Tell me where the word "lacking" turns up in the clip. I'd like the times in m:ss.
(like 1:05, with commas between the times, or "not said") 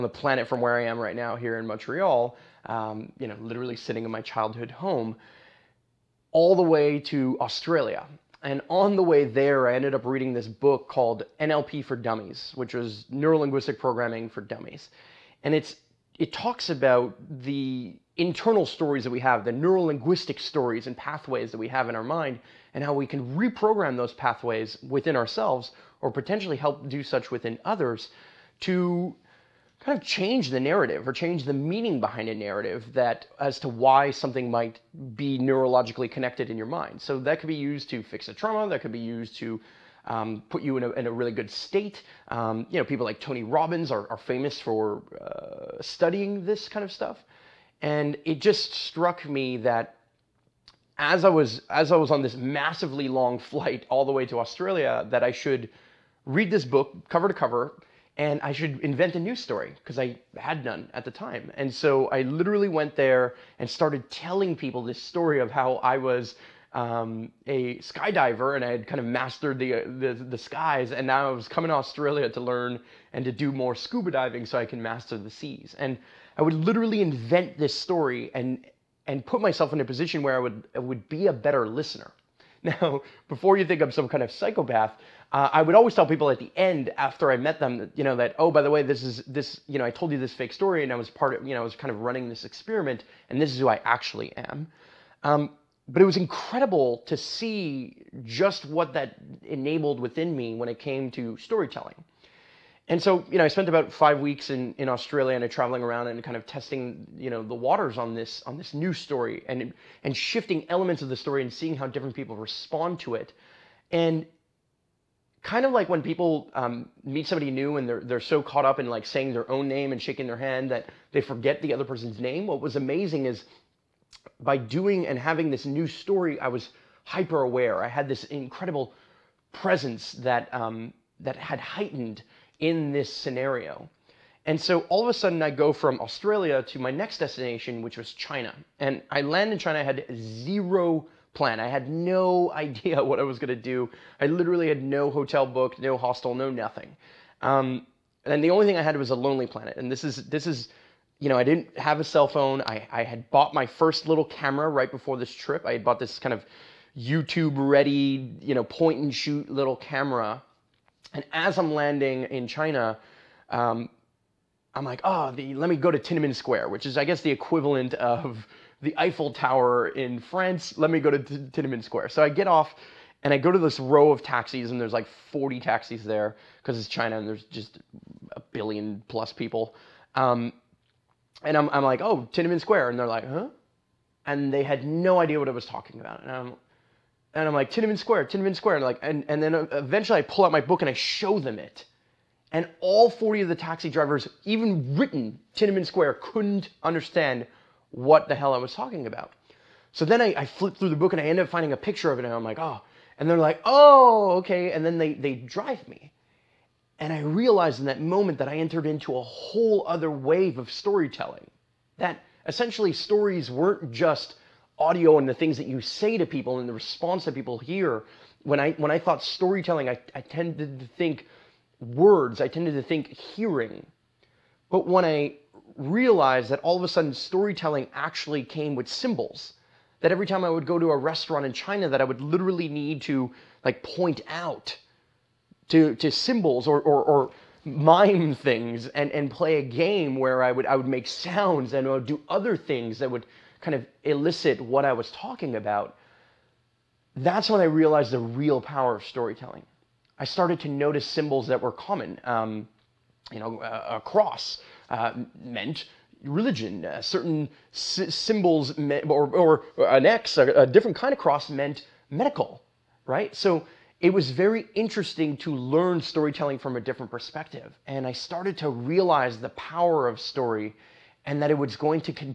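not said.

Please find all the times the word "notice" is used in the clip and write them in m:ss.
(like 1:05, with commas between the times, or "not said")
4:10.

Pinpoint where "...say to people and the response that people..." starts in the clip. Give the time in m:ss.
3:35.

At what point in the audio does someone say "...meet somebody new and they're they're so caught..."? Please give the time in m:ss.
1:57.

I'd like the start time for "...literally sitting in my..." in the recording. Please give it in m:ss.
0:03.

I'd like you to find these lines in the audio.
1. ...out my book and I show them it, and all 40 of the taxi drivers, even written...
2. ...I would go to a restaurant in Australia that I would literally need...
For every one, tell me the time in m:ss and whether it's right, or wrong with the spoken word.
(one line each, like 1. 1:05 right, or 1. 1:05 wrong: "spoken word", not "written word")
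1. 3:10 right
2. 3:50 wrong: "China", not "Australia".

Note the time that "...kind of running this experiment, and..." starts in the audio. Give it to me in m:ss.
1:31.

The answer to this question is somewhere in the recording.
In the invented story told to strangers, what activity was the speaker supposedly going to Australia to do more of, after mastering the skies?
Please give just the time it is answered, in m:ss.
1:13.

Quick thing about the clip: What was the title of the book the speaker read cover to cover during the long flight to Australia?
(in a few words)
NLP for Dummies.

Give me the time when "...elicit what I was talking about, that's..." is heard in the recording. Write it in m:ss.
4:04.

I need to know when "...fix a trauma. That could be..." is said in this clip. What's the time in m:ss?
0:38.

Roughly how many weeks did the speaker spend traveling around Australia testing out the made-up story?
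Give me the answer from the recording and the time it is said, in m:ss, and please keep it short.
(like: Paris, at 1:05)
5, at 1:43.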